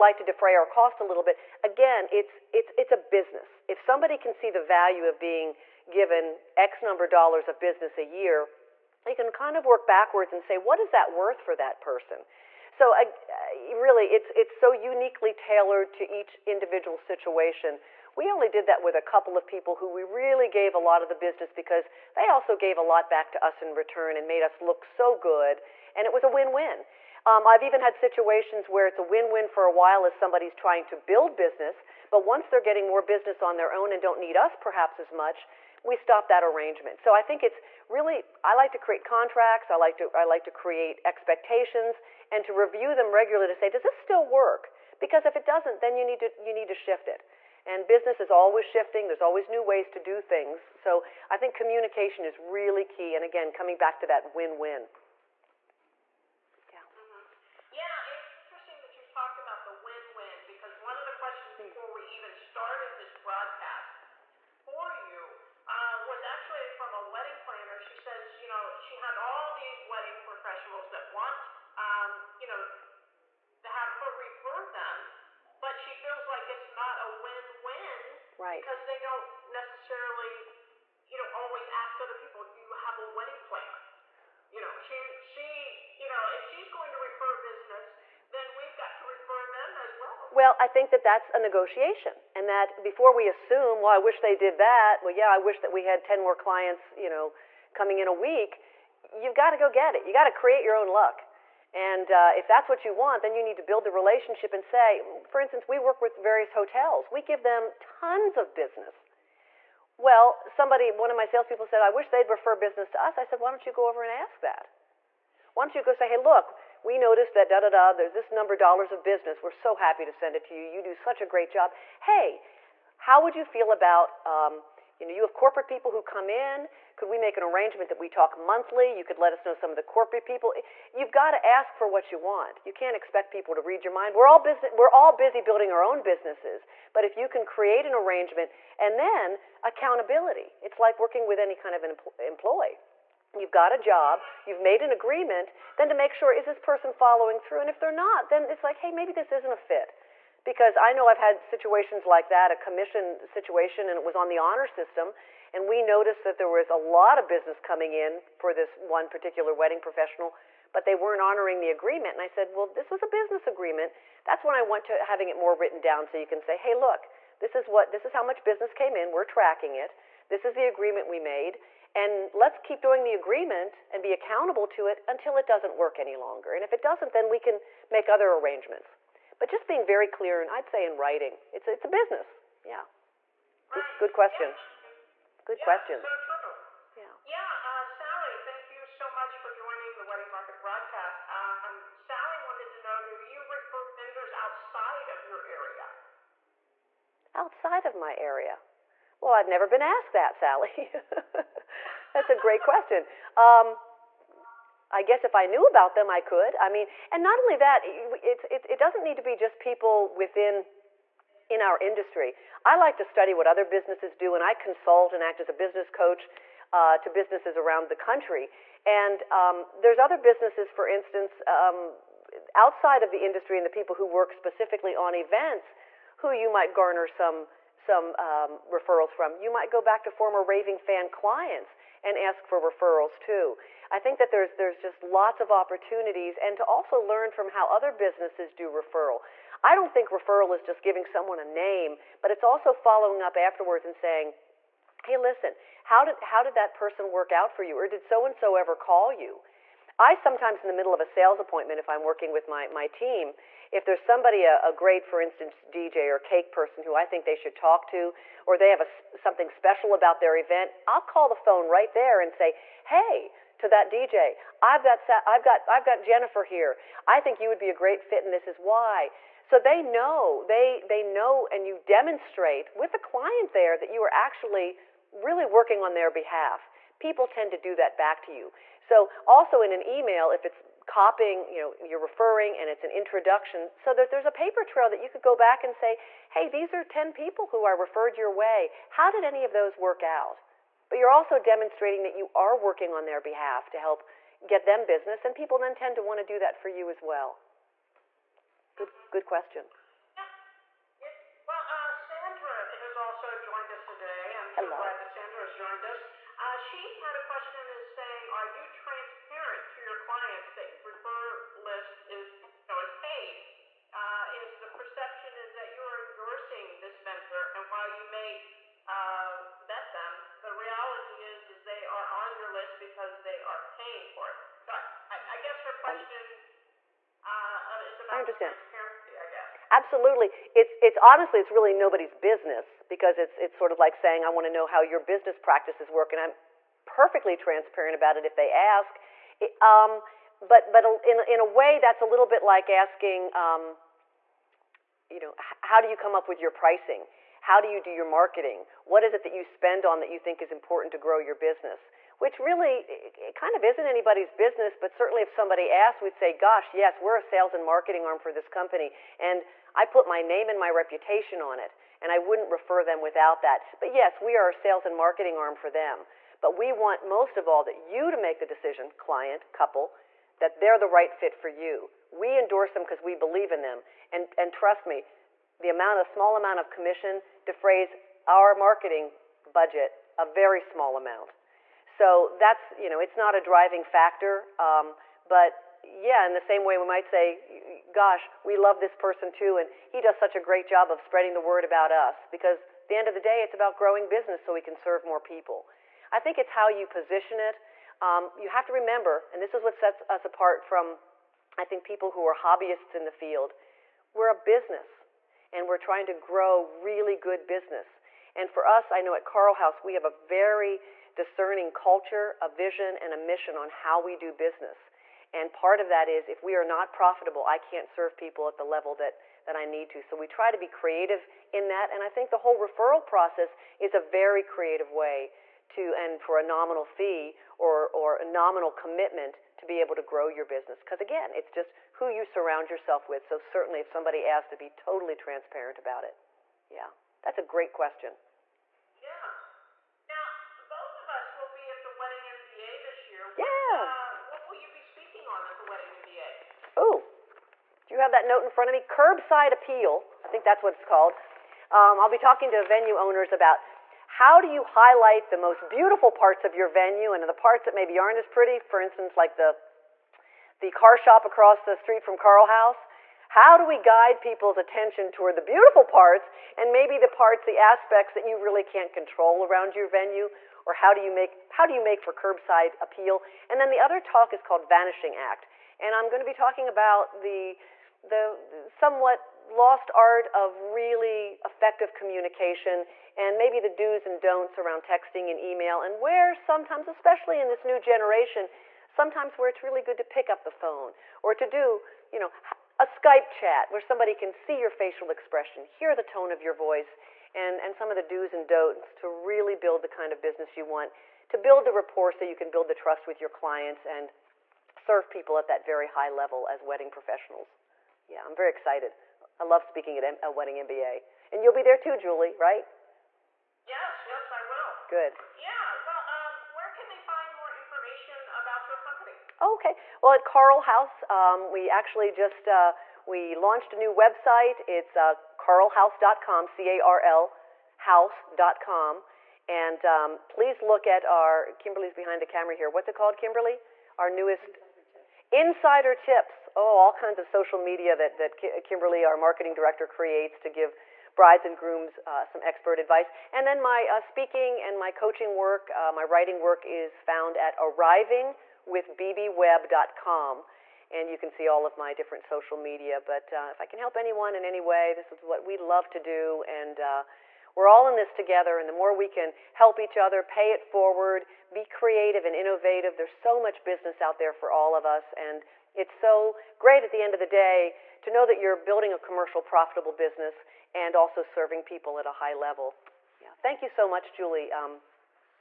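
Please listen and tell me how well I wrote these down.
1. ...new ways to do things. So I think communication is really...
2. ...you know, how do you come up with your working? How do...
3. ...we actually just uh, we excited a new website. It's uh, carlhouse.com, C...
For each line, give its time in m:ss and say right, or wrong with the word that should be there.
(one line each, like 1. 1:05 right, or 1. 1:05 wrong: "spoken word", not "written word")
1. 0:49 right
2. 5:45 wrong: "pricing", not "working"
3. 8:41 wrong: "launched", not "excited".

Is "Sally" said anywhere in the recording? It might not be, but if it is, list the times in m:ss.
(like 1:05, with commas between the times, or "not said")
3:07, 3:11, 3:20.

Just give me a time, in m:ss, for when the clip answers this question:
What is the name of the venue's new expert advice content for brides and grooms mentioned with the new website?
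8:55.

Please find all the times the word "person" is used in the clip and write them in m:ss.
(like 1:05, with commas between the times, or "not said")
0:11, 2:26, 4:06, 4:16, 6:28.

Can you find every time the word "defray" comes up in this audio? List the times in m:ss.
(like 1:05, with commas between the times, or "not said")
0:00, 6:17.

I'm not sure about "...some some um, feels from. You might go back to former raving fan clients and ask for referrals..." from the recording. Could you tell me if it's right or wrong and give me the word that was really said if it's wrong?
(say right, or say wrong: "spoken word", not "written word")
wrong: "referrals", not "feels".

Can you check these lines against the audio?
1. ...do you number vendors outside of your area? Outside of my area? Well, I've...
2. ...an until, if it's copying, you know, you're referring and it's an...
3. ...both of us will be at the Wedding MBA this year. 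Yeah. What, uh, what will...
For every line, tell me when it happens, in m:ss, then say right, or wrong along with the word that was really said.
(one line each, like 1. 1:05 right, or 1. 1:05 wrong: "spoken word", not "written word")
1. 3:13 wrong: "refer", not "number"
2. 4:39 wrong: "email", not "until"
3. 7:20 right.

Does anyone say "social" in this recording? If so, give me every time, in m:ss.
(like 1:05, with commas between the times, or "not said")
8:57, 9:12.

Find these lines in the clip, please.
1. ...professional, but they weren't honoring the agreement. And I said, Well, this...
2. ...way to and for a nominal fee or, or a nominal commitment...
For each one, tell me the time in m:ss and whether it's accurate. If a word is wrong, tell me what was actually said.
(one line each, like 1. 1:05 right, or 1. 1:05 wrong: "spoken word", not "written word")
1. 2:39 right
2. 7:04 right.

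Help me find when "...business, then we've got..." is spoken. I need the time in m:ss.
1:27.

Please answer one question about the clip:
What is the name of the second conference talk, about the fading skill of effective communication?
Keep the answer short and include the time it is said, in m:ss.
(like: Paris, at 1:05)
Vanishing Act, at 7:54.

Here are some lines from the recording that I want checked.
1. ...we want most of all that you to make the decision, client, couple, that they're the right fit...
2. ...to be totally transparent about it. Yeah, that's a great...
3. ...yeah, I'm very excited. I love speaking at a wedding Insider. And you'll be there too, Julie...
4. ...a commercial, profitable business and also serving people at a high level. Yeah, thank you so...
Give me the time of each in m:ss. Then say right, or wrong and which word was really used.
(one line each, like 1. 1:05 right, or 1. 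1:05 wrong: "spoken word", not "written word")
1. 6:06 right
2. 7:14 right
3. 8:28 wrong: "MBA", not "Insider"
4. 9:28 right.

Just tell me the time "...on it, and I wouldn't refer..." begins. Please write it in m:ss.
6:01.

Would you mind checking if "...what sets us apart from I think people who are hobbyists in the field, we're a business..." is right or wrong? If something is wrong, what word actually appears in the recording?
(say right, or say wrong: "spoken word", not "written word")
right.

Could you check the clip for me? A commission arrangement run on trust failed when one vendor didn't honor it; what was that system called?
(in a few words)
the honor system.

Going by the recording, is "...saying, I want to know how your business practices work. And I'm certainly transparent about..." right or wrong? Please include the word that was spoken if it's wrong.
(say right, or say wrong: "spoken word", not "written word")
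wrong: "perfectly", not "certainly".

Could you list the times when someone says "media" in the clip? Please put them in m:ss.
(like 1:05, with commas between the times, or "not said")
8:57, 9:12.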